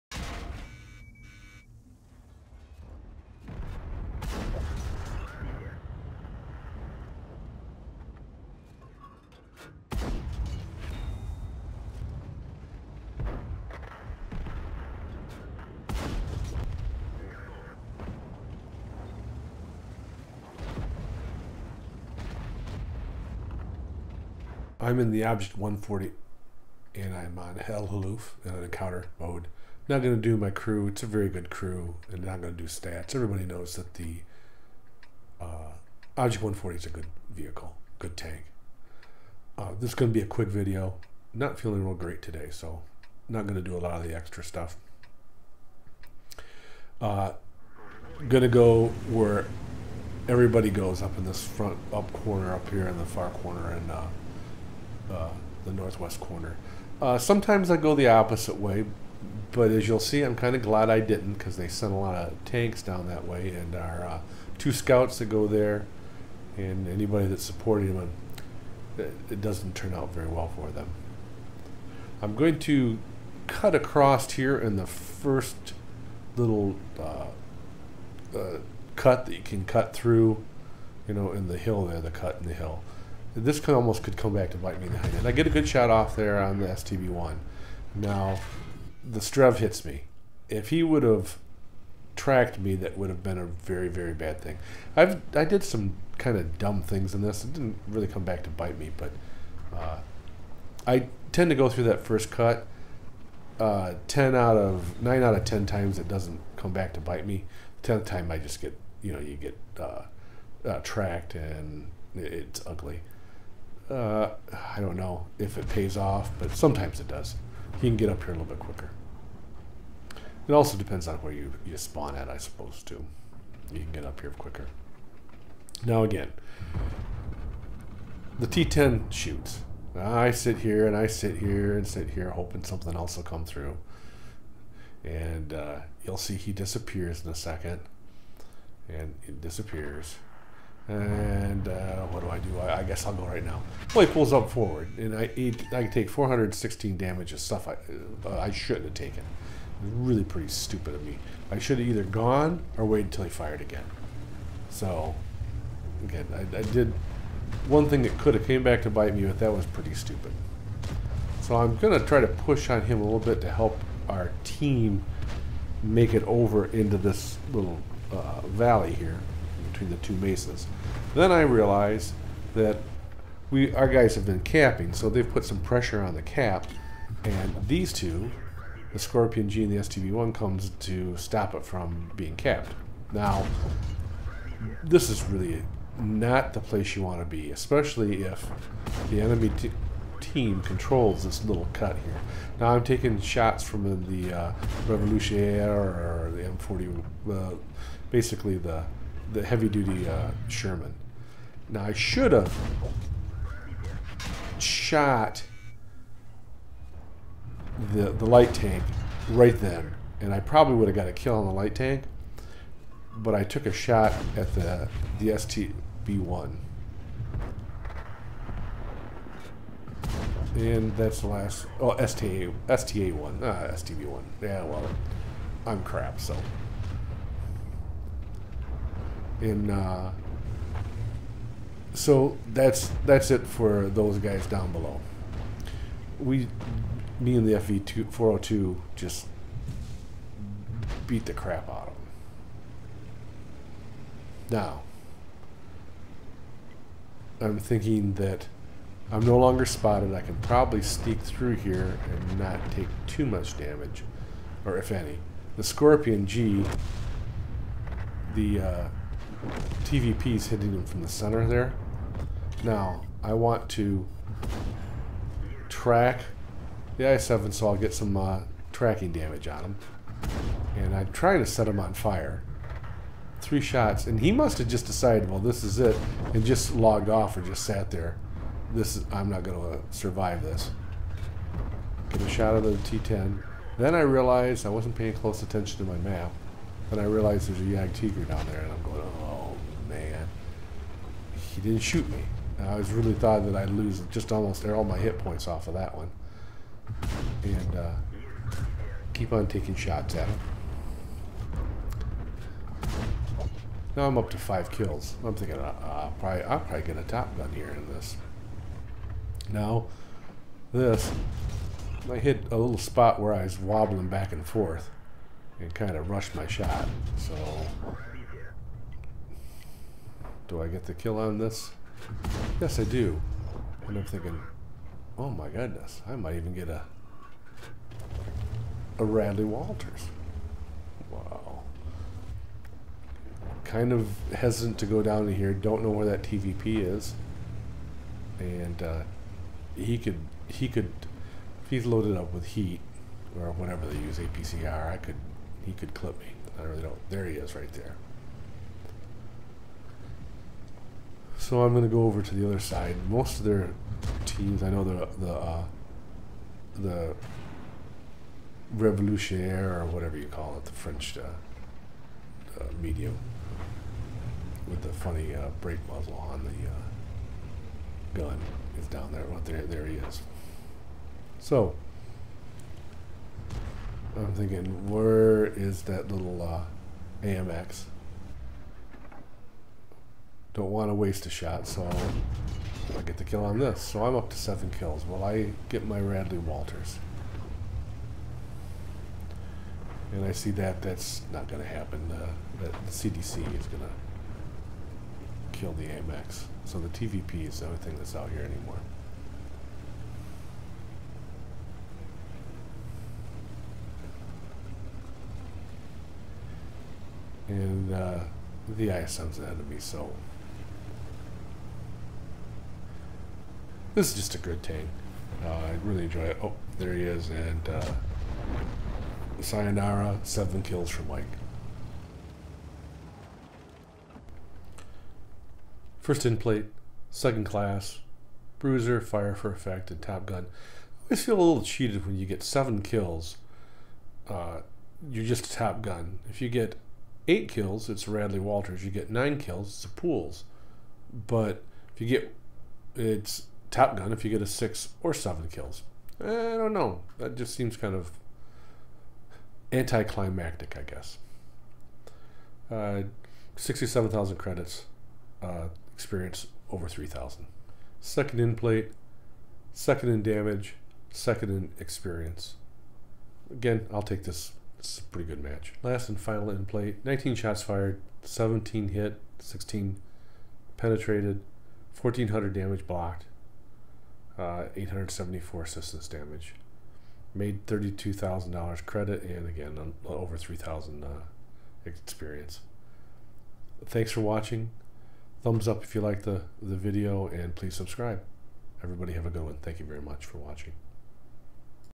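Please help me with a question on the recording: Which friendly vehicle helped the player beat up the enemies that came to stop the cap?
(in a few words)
FE hundred oh two.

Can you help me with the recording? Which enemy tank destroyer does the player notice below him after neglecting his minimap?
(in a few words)
Jagdtiger.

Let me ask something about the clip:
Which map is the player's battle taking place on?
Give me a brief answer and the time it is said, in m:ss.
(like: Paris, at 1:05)
El Halluf, at 0:27.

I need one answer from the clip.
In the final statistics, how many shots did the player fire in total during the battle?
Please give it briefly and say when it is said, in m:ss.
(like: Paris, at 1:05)
19, at 7:47.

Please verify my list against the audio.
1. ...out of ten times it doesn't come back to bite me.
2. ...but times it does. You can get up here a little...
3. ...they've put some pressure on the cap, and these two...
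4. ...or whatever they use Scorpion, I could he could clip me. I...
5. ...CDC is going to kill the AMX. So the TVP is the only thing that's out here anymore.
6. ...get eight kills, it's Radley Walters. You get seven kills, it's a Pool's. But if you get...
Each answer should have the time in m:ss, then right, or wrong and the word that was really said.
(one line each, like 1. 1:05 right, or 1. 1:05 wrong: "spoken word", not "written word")
1. 1:45 right
2. 1:56 wrong: "sometimes", not "times"
3. 2:55 right
4. 5:43 wrong: "APCR", not "Scorpion"
5. 6:32 right
6. 7:16 wrong: "nine", not "seven".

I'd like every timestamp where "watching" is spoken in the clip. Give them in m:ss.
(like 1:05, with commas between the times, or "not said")
8:04, 8:10.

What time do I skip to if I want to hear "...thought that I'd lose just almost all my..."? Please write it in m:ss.
4:53.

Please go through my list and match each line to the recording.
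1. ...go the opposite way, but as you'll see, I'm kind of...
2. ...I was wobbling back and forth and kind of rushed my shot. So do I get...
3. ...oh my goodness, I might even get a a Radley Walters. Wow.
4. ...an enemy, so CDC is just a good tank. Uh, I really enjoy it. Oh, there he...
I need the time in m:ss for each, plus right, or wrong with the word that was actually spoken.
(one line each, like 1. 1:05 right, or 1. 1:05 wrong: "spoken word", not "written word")
1. 0:57 right
2. 5:13 right
3. 5:25 right
4. 6:49 wrong: "This", not "CDC".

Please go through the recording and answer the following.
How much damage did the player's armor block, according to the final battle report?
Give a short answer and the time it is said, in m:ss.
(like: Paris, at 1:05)
1400, at 7:52.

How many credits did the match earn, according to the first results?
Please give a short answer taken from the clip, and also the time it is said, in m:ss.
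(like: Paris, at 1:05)
67,000, at 7:33.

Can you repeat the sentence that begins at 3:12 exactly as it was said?
Now I'm taking shots from the uh, Revolutionaire or the M40, uh, basically the the heavy duty uh, Sherman.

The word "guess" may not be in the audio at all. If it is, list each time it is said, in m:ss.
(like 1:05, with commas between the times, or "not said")
2:22, 7:30.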